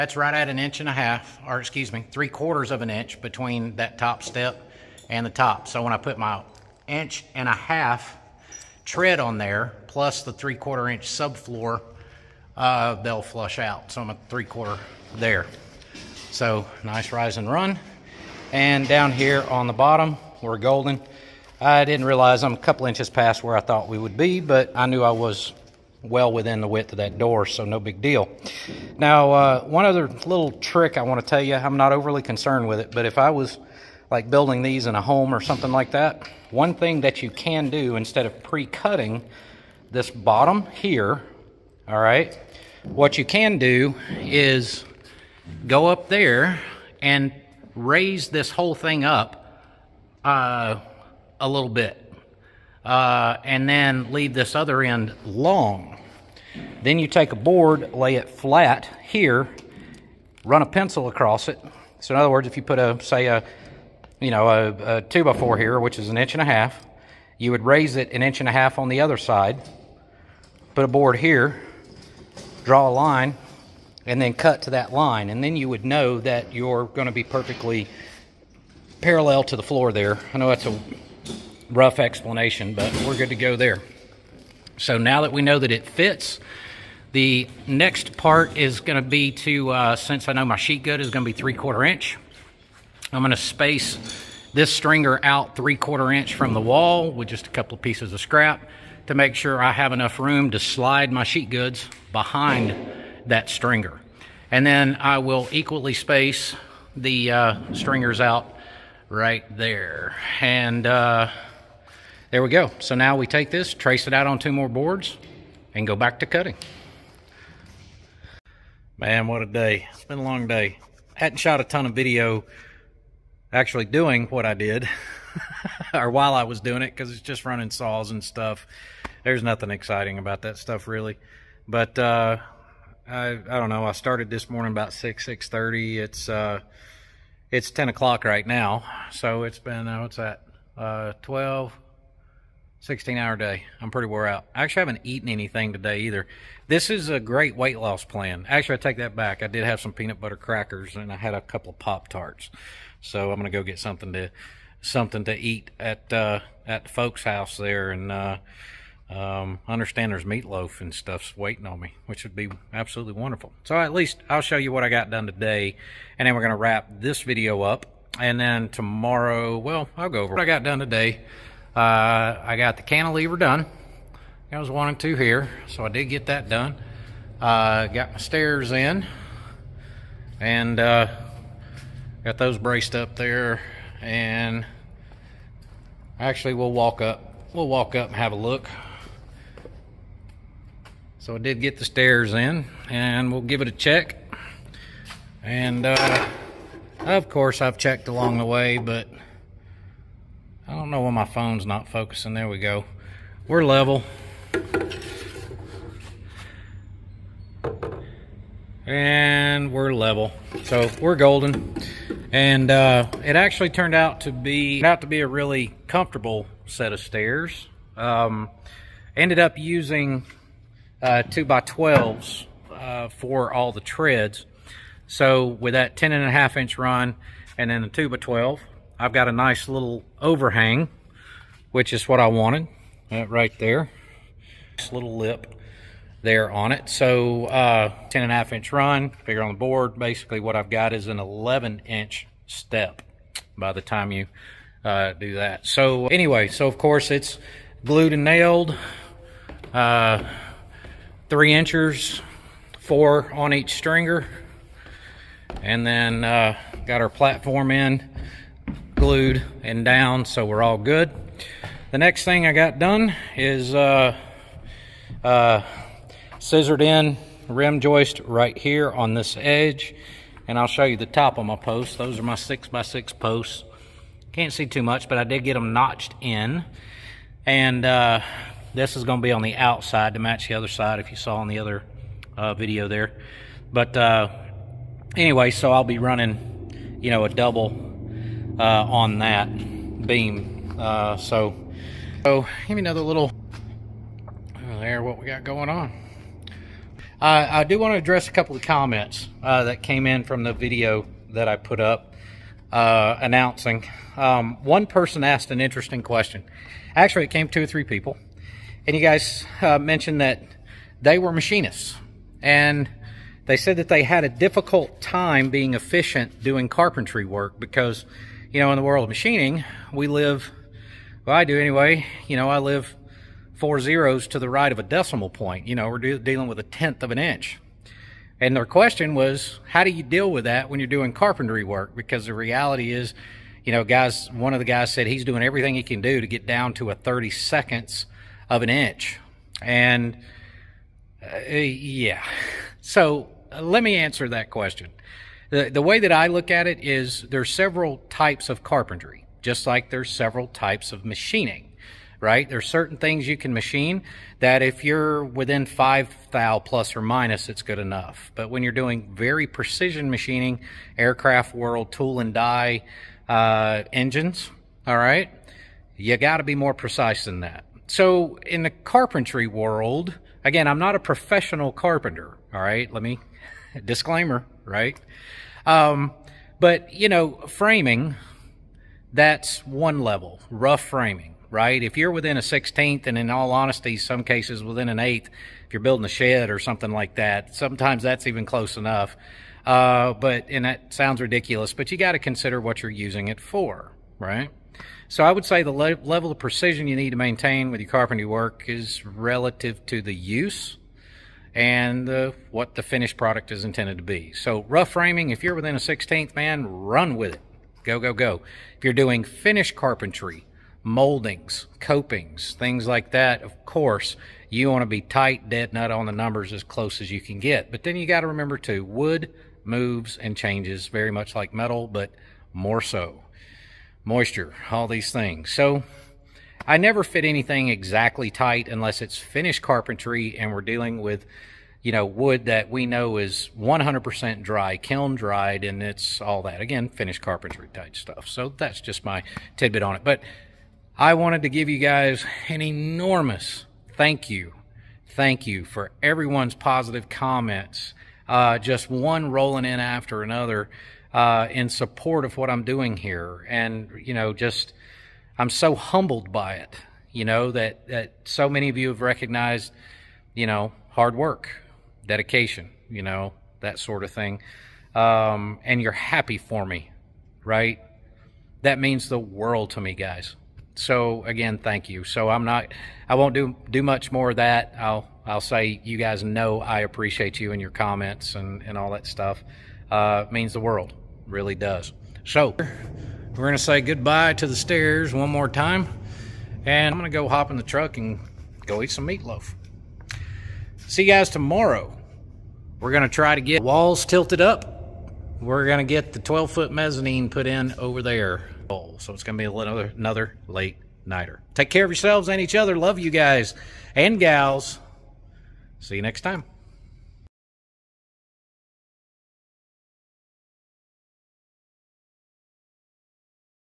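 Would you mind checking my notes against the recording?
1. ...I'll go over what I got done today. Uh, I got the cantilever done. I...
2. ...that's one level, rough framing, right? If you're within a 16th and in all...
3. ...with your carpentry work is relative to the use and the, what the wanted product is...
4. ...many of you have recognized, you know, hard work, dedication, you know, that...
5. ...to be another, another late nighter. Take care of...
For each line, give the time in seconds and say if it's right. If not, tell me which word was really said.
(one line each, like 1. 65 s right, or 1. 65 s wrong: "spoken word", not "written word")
1. 169 s right
2. 379 s right
3. 397 s wrong: "finished", not "wanted"
4. 458 s right
5. 499 s right.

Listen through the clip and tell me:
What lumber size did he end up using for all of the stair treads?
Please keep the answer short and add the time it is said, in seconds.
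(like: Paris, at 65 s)
2 by 12s, at 221 s.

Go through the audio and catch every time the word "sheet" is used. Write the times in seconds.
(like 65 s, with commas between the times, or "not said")
90 s, 101 s.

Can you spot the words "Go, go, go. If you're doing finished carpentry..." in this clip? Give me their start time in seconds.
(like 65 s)
407 s.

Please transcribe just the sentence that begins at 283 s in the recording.
But uh, anyway, so I'll be running, you know, a double uh, on that beam.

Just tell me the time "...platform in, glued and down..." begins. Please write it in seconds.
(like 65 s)
257 s.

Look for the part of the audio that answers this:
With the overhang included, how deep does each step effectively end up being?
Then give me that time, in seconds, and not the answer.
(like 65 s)
241 s.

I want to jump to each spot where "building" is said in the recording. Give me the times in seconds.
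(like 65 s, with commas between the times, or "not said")
34 s, 385 s.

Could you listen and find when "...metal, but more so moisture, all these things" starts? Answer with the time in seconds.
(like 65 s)
421 s.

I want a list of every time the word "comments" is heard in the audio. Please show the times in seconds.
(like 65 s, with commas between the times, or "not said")
298 s, 447 s, 477 s.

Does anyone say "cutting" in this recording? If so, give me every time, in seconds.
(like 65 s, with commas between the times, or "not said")
38 s, 116 s.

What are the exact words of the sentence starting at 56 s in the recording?
Then you take a board, lay it flat here, run a pencil across it.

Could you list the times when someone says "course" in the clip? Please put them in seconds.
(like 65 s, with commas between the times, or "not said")
197 s, 246 s, 413 s.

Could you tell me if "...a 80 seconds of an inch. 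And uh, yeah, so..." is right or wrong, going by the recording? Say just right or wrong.
wrong.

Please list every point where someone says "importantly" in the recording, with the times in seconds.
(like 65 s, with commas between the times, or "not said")
not said.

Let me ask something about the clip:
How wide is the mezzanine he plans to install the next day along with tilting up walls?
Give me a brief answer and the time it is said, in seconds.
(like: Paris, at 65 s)
12-foot, at 496 s.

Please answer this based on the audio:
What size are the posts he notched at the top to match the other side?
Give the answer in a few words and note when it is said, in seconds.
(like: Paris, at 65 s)
6 by 6, at 272 s.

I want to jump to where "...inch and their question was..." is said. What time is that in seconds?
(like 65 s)
327 s.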